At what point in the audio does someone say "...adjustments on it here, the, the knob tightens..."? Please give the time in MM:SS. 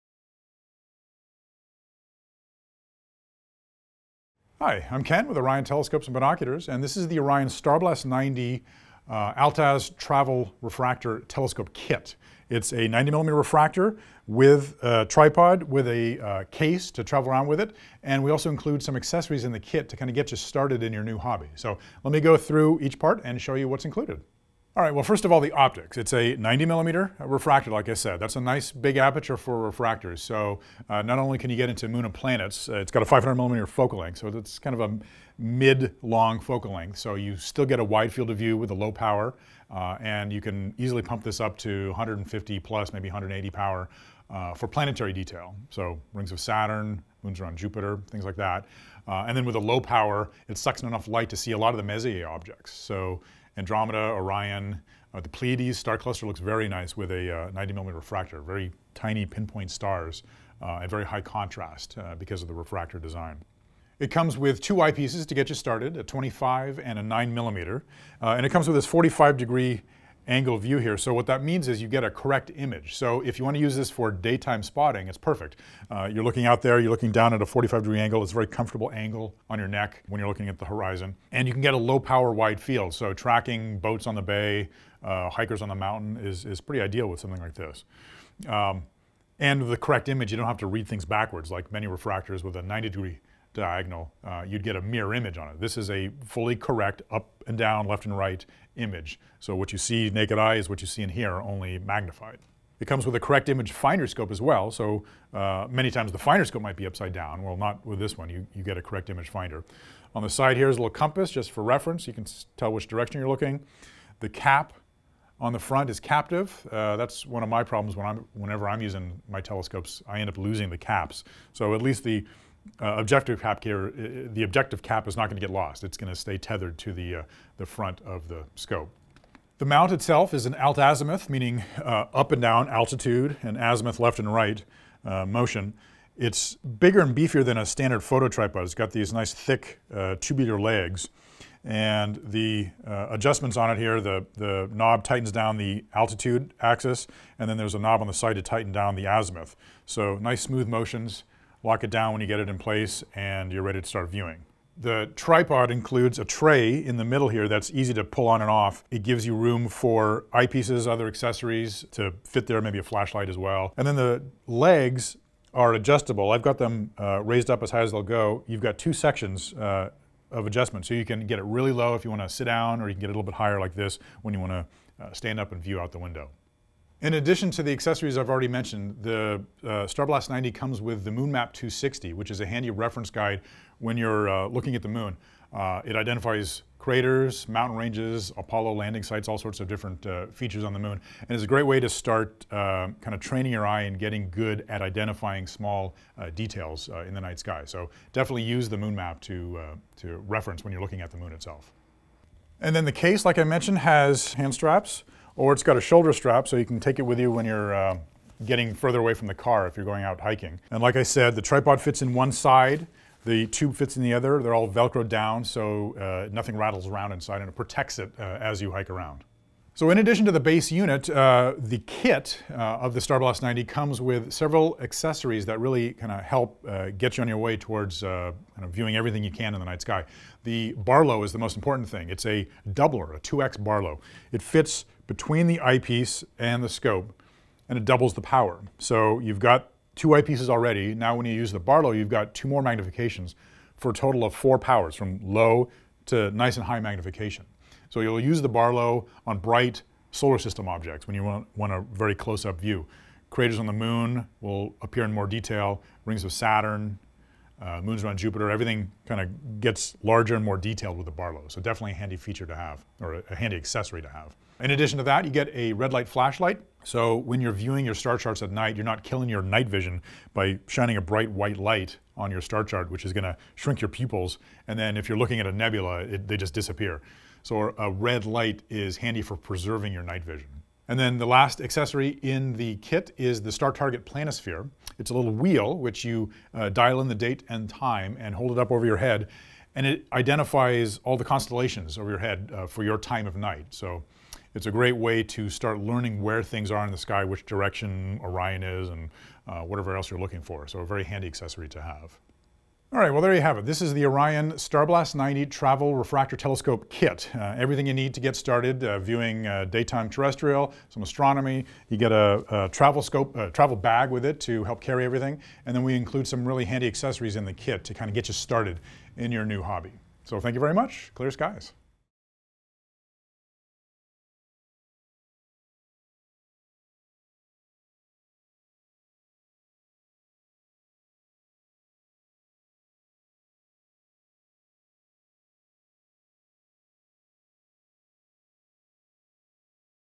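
02:23.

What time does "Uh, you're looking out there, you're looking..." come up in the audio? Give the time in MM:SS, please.
01:15.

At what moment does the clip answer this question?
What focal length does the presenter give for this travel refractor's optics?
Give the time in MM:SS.
00:33.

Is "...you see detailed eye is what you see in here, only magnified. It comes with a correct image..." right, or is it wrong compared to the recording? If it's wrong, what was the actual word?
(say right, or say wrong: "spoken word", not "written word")
wrong: "naked", not "detailed".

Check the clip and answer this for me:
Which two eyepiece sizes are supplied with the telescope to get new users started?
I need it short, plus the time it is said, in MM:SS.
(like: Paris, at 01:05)
25 and 9 millimeter, at 01:05.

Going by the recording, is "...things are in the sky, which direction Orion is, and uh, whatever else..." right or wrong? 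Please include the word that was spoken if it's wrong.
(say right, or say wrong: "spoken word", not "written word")
right.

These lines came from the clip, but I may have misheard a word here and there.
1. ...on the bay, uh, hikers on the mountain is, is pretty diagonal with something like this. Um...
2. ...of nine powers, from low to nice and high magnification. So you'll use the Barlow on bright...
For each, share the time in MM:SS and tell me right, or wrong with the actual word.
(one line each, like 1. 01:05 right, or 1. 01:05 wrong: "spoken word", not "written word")
1. 01:24 wrong: "ideal", not "diagonal"
2. 04:04 wrong: "four", not "nine".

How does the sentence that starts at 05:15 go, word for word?
And then we include some really handy accessories in the kit to kind of get you started in your new hobby.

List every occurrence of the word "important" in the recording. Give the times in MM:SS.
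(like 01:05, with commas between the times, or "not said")
03:51.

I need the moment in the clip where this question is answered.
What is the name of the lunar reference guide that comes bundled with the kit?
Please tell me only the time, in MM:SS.
03:01.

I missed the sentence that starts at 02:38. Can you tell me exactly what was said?
It gives you room for eyepieces, other accessories to fit there, maybe a flashlight as well.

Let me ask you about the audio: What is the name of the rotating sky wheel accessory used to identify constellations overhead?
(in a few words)
Star Target Planisphere.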